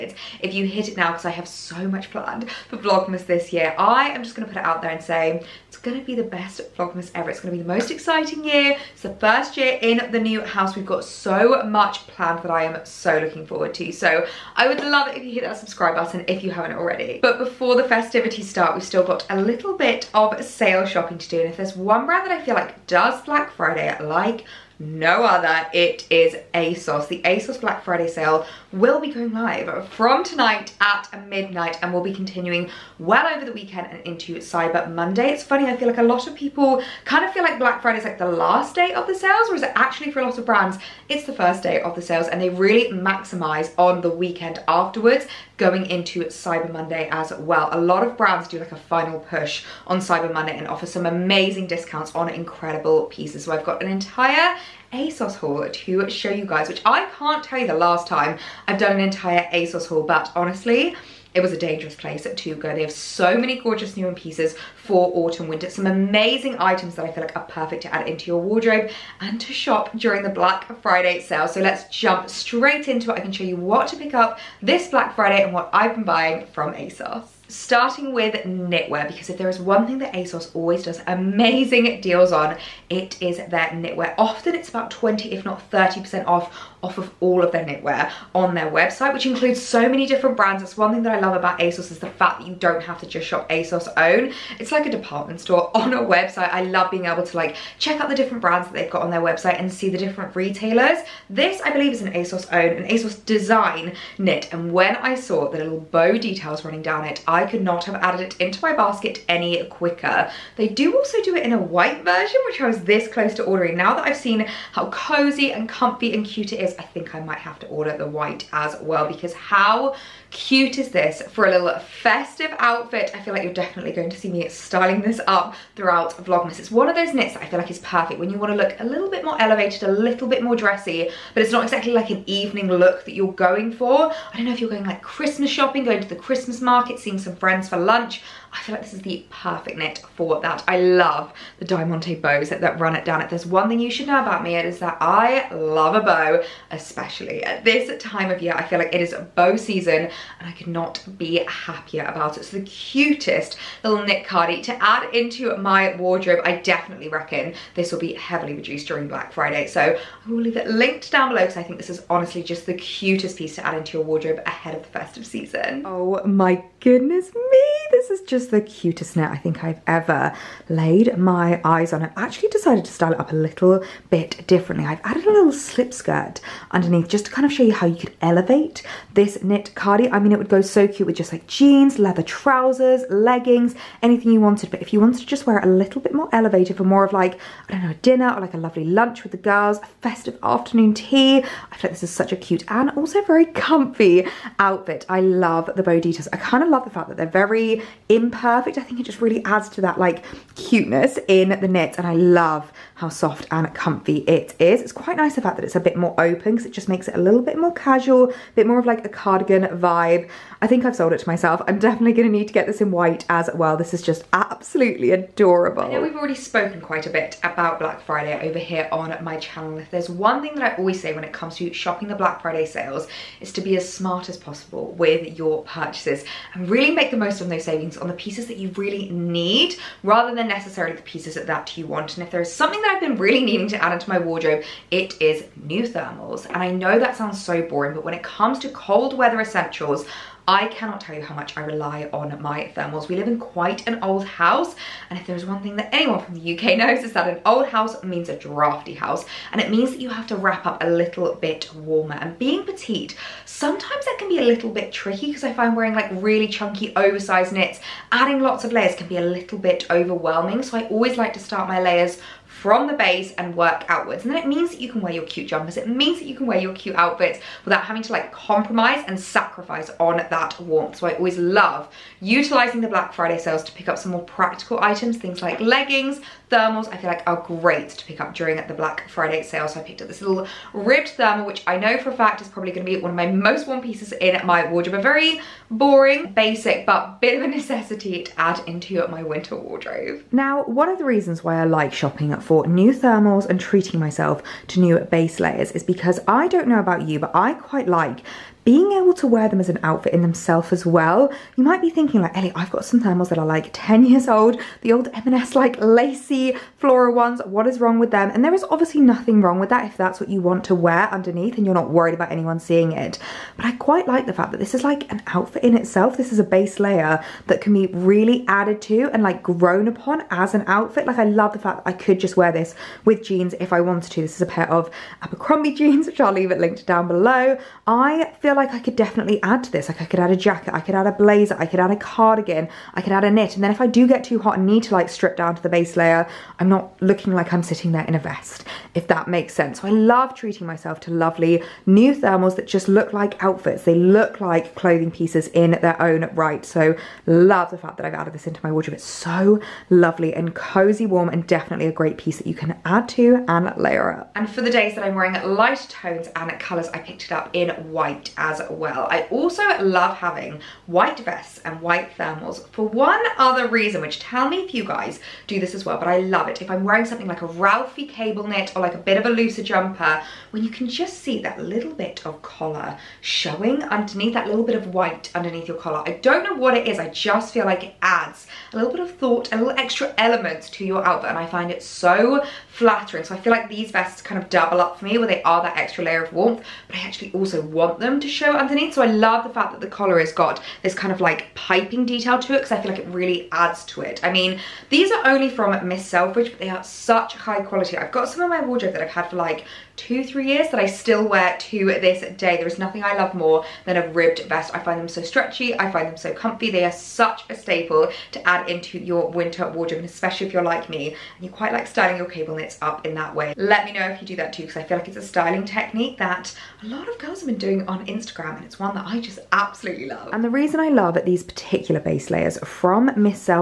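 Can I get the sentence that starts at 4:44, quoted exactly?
A very boring, basic, but bit of a necessity to add into my winter wardrobe.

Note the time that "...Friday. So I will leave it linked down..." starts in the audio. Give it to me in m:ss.
2:39.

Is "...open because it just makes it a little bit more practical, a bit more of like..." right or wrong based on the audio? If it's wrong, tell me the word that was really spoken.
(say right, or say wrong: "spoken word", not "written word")
wrong: "casual", not "practical".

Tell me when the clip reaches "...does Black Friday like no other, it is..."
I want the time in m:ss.
0:22.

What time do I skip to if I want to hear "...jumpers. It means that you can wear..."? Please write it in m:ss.
4:25.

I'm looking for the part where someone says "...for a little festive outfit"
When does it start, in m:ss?
2:01.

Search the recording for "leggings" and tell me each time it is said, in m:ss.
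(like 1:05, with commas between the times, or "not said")
3:03, 4:35.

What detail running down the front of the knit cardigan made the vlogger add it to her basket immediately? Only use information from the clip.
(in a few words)
little bow details.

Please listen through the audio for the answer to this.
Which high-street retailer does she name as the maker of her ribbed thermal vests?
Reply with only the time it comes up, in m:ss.
6:35.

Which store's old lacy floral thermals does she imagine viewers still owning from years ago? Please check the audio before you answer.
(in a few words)
M&S.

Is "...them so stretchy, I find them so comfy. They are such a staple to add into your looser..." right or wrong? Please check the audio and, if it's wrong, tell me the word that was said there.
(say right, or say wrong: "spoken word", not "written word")
wrong: "winter", not "looser".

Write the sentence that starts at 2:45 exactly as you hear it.
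Oh my goodness me, this is just was the cutest knit I think I've ever laid my eyes on.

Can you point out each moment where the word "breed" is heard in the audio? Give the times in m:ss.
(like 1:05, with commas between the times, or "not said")
not said.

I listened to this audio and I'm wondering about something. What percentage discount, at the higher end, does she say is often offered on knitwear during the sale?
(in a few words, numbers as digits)
30%.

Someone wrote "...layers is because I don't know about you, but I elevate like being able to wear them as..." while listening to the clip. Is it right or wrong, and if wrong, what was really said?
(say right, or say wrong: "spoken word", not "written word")
wrong: "quite", not "elevate".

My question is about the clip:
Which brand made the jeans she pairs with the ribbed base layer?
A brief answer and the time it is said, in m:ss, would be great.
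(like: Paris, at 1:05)
Abercrombie, at 5:25.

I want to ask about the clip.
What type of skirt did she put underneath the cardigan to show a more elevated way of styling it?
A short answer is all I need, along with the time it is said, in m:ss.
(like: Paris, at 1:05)
slip skirt, at 2:55.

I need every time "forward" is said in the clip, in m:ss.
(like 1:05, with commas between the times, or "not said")
0:13.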